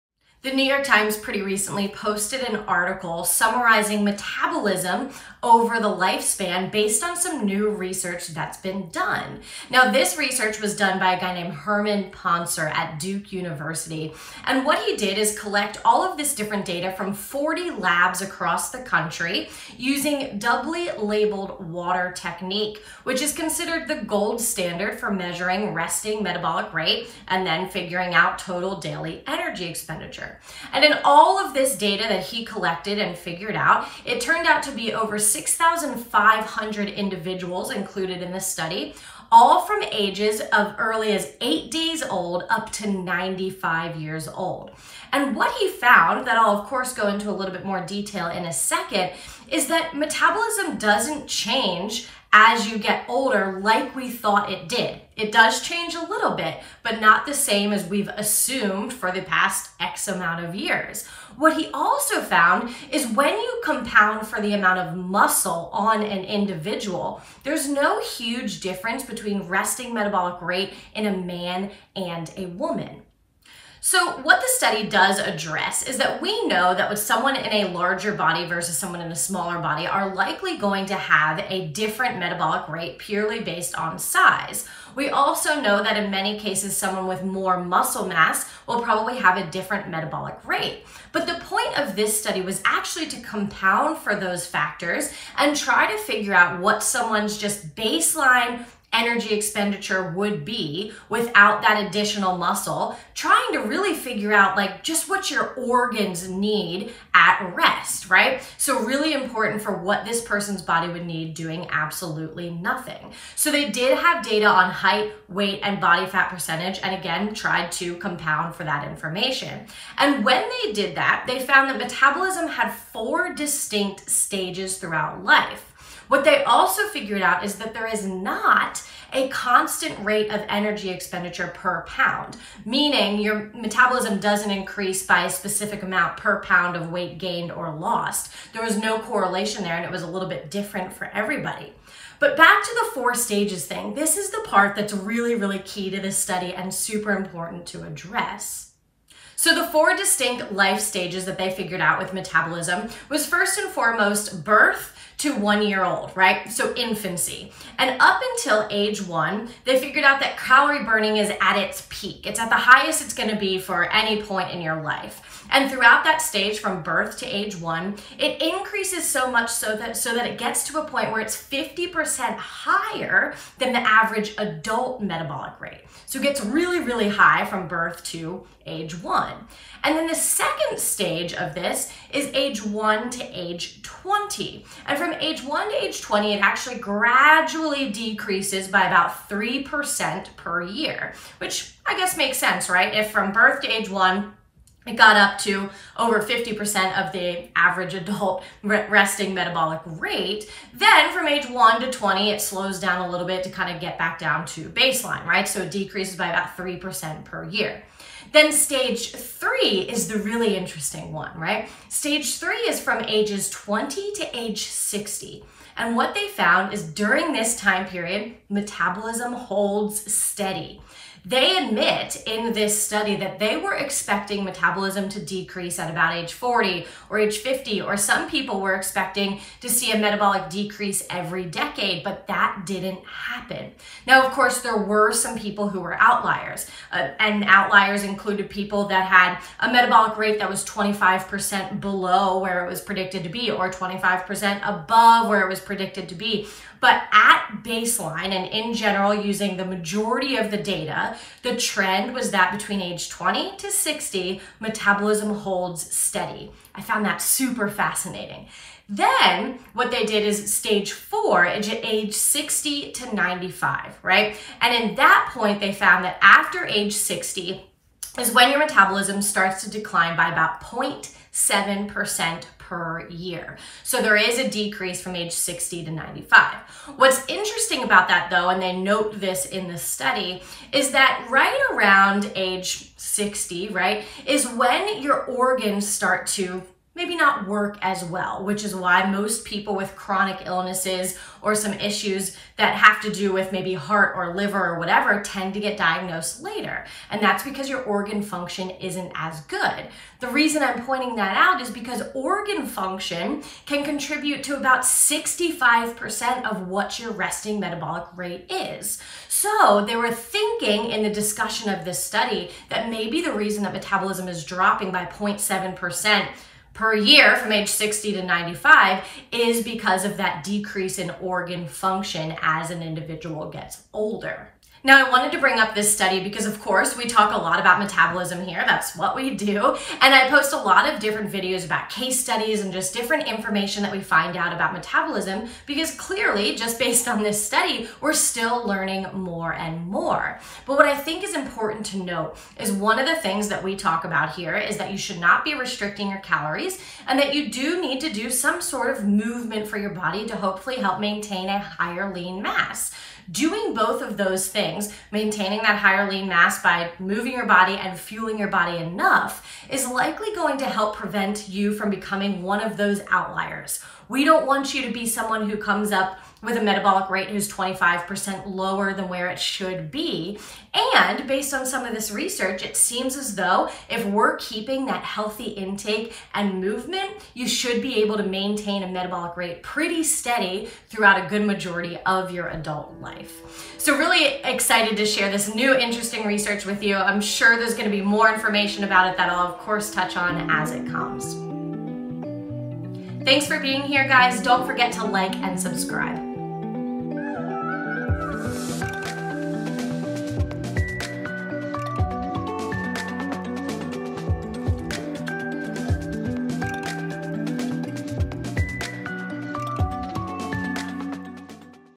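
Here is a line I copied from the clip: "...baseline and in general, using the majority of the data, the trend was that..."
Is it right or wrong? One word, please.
right.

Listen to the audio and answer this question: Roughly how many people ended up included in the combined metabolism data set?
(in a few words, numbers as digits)
Over 6,500.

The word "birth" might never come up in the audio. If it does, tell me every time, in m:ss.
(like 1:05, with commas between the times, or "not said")
2:34, 2:46, 2:57, 3:13.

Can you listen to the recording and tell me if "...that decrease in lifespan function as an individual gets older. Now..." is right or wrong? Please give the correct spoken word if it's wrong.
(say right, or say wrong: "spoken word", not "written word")
wrong: "organ", not "lifespan".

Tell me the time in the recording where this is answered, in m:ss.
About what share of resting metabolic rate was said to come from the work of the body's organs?
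5:04.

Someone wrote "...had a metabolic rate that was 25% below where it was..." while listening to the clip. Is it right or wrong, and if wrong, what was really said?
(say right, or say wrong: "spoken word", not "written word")
right.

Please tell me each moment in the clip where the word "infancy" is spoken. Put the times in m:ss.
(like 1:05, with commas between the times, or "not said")
2:36.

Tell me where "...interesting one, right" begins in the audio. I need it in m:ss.
3:30.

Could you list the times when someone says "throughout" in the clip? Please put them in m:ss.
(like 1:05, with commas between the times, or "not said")
2:04, 2:45, 6:20.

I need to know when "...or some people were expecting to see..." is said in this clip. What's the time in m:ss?
3:47.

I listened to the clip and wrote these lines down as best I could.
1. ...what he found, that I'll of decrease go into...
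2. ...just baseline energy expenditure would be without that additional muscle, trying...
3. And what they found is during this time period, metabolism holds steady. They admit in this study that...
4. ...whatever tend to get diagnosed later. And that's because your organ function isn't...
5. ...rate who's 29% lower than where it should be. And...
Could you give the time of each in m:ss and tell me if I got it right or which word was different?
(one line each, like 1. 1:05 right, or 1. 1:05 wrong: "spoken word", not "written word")
1. 0:45 wrong: "course", not "decrease"
2. 1:37 right
3. 3:35 right
4. 4:54 right
5. 6:07 wrong: "25", not "29".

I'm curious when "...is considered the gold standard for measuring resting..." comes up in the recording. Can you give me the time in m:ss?
0:23.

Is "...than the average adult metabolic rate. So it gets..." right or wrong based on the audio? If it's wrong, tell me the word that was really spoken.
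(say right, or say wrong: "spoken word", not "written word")
right.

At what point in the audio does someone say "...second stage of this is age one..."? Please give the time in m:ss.
3:00.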